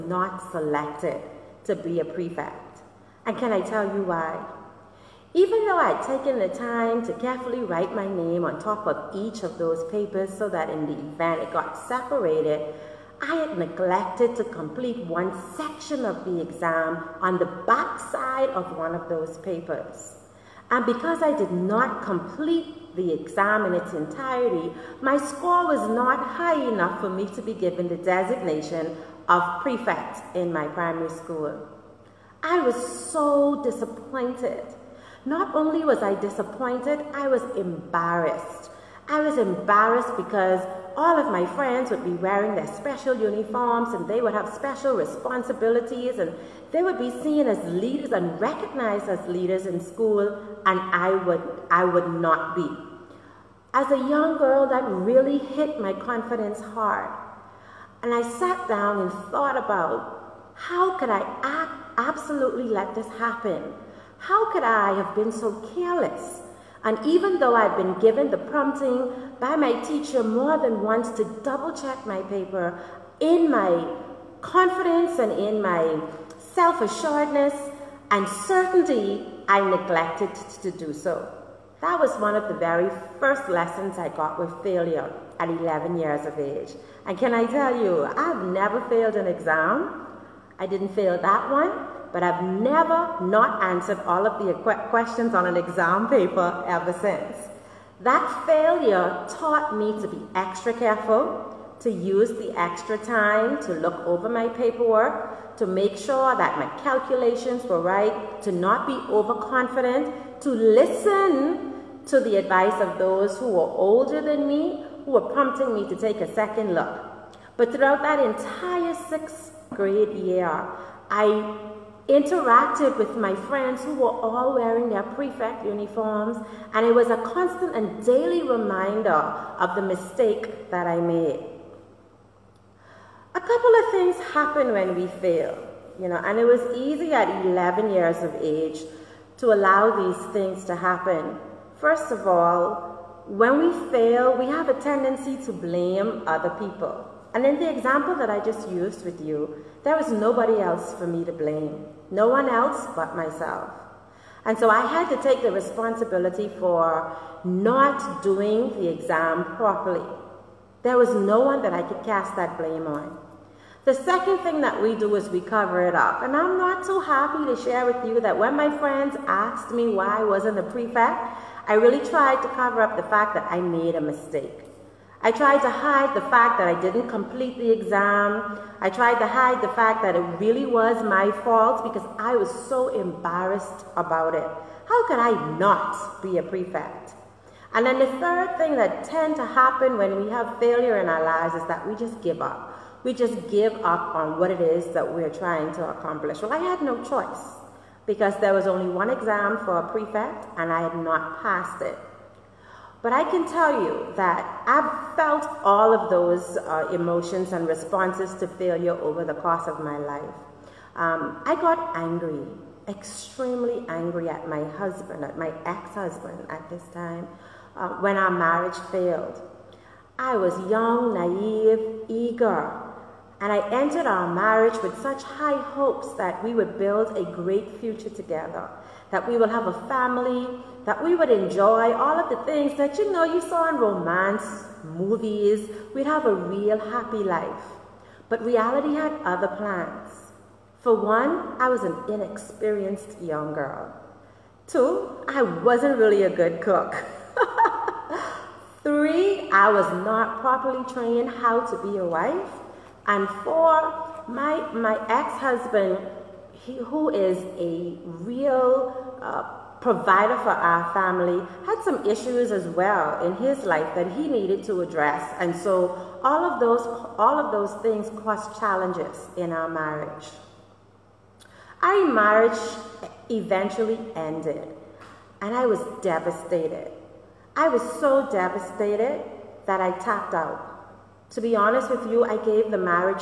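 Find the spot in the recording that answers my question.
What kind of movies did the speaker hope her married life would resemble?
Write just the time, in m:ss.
3:53.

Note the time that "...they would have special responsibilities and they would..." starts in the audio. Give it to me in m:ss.
0:44.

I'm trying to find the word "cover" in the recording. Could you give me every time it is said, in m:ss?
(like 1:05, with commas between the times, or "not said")
2:45, 2:52.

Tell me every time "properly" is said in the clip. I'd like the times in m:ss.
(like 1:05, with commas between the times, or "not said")
2:39, 4:10.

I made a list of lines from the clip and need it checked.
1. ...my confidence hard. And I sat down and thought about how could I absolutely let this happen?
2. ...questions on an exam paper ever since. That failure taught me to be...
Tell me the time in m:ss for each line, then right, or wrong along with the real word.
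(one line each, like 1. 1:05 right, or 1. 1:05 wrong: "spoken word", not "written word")
1. 0:55 right
2. 1:34 right.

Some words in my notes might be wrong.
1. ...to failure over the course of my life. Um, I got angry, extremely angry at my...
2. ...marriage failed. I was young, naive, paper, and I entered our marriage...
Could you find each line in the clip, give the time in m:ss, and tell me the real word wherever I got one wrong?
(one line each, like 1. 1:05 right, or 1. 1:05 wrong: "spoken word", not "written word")
1. 3:28 right
2. 3:38 wrong: "eager", not "paper".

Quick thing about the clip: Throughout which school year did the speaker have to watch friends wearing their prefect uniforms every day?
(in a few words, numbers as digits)
sixth grade.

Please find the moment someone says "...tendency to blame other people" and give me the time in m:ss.
2:24.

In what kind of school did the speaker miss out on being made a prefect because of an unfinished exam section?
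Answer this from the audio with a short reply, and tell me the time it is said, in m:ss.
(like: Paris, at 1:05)
primary school, at 0:30.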